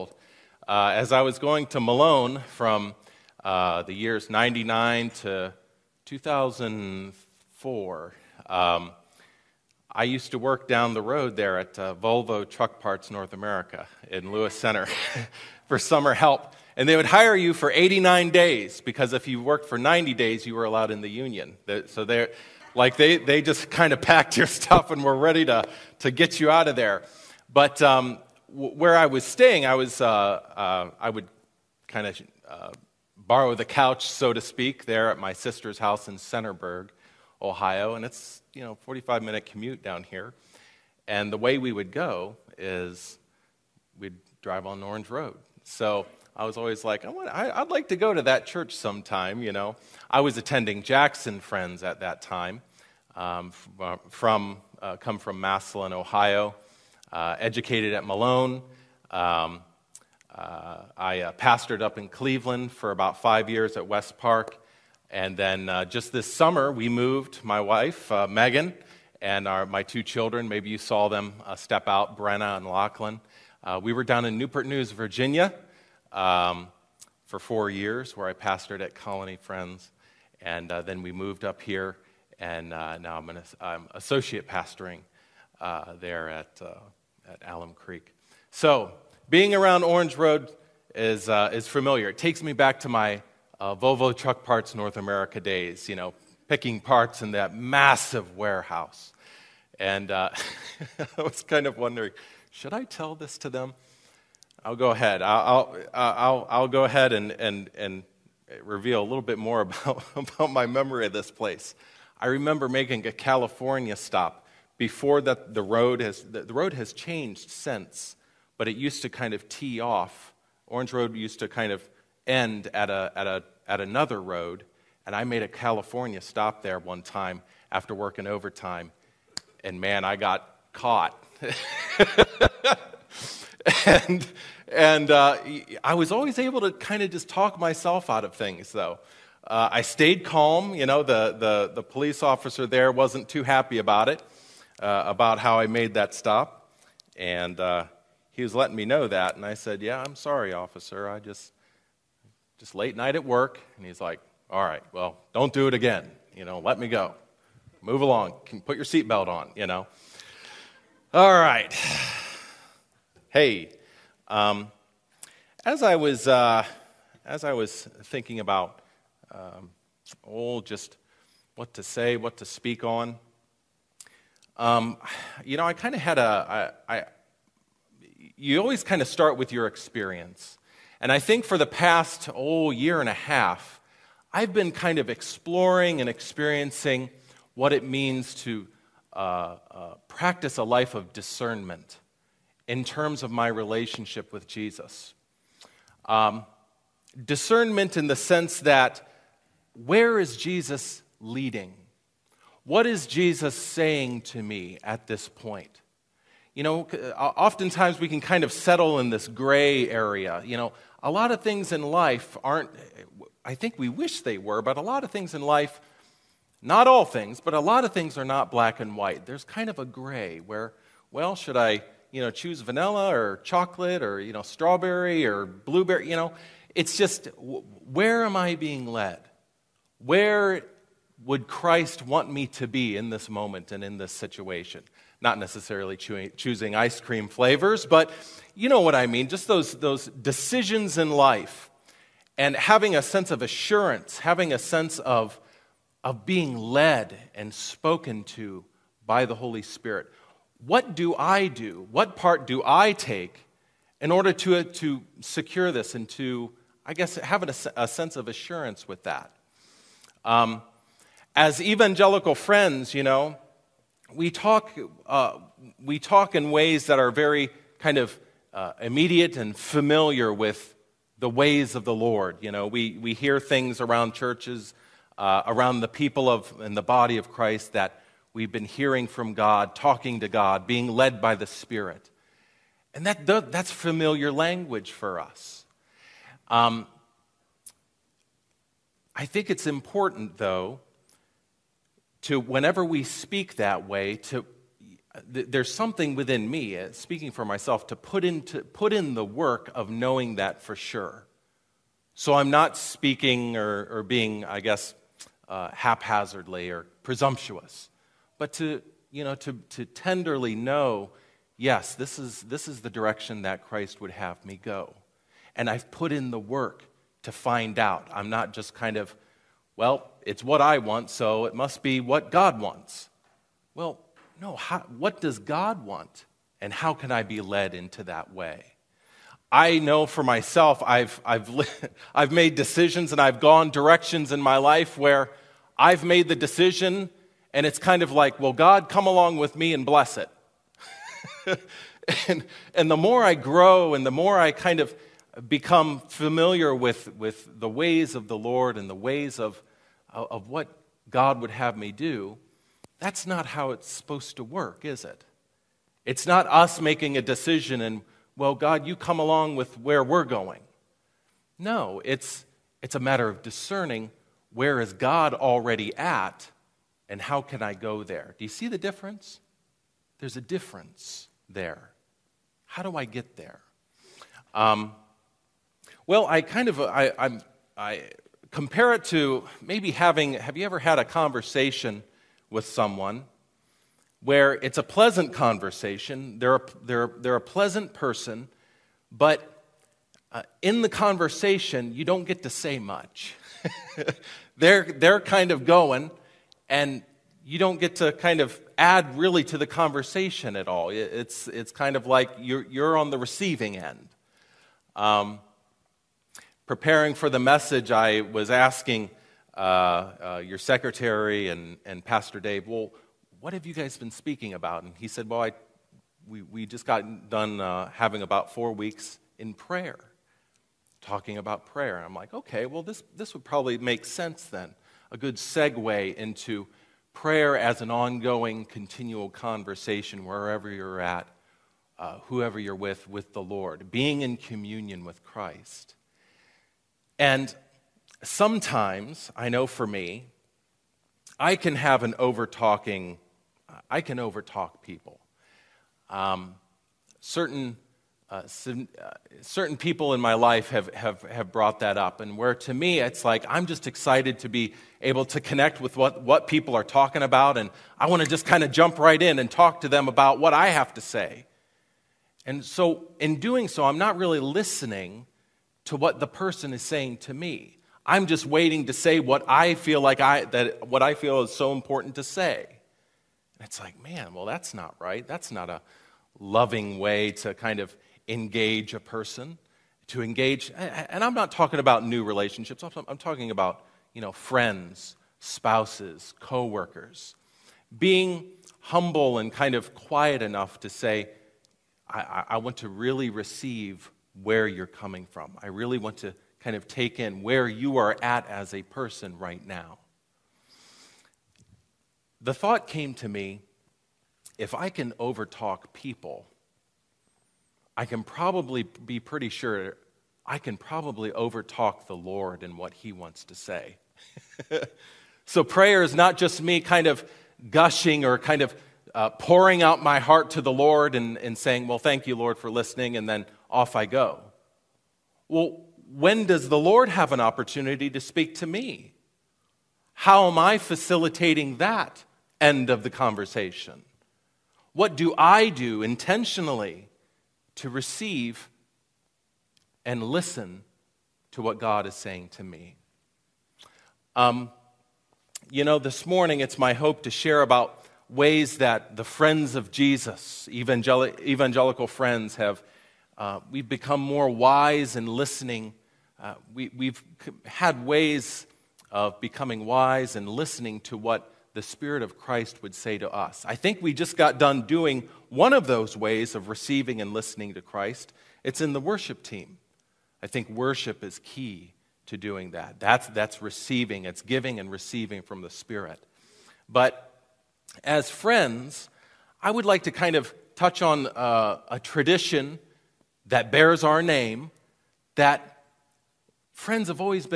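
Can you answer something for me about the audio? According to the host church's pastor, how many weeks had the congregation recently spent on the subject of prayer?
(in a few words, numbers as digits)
4.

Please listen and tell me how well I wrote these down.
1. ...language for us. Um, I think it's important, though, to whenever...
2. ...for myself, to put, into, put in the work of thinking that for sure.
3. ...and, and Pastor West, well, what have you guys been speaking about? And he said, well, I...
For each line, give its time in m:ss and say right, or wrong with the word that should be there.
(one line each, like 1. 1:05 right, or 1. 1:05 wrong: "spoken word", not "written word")
1. 4:44 right
2. 4:57 wrong: "knowing", not "thinking"
3. 6:51 wrong: "Dave", not "West".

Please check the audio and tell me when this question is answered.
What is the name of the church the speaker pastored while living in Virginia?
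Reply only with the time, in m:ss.
1:18.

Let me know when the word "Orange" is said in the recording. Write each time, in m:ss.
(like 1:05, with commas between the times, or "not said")
0:44, 1:29, 2:00.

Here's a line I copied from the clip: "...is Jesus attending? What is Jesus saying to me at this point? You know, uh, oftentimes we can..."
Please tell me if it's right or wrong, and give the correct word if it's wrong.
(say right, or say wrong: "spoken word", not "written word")
wrong: "leading", not "attending".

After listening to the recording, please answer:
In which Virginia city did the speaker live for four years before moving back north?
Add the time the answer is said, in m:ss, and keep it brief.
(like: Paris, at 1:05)
Newport News, at 1:14.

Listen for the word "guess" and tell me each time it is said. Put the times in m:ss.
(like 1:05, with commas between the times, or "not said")
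4:16, 5:04.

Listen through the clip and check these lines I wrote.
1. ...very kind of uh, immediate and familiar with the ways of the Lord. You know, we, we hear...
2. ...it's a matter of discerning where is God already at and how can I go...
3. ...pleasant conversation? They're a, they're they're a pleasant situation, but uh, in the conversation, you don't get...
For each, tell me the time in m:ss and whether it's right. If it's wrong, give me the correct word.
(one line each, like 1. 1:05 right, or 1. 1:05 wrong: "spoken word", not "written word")
1. 4:27 right
2. 6:02 right
3. 6:24 wrong: "person", not "situation".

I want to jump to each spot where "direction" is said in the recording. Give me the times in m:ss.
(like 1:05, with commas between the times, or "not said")
5:12, 5:33.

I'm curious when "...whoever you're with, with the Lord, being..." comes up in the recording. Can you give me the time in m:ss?
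7:12.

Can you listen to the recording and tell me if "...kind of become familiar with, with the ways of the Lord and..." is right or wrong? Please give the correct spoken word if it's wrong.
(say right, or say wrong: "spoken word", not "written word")
right.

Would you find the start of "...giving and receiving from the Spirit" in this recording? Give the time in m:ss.
9:34.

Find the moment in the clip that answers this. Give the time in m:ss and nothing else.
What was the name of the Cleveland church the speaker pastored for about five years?
1:03.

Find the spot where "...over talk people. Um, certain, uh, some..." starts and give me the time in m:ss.
7:24.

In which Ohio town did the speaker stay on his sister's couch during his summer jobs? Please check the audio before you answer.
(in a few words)
Centerburg.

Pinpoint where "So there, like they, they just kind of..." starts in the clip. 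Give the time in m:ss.
0:21.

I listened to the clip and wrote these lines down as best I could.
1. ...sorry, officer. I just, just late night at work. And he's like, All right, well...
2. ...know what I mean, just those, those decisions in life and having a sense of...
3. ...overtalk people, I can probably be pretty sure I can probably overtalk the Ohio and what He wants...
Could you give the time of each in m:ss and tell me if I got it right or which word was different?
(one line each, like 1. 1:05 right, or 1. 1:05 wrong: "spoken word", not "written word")
1. 2:30 right
2. 3:58 right
3. 8:25 wrong: "Lord", not "Ohio".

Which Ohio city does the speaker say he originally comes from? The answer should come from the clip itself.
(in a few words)
Massillon.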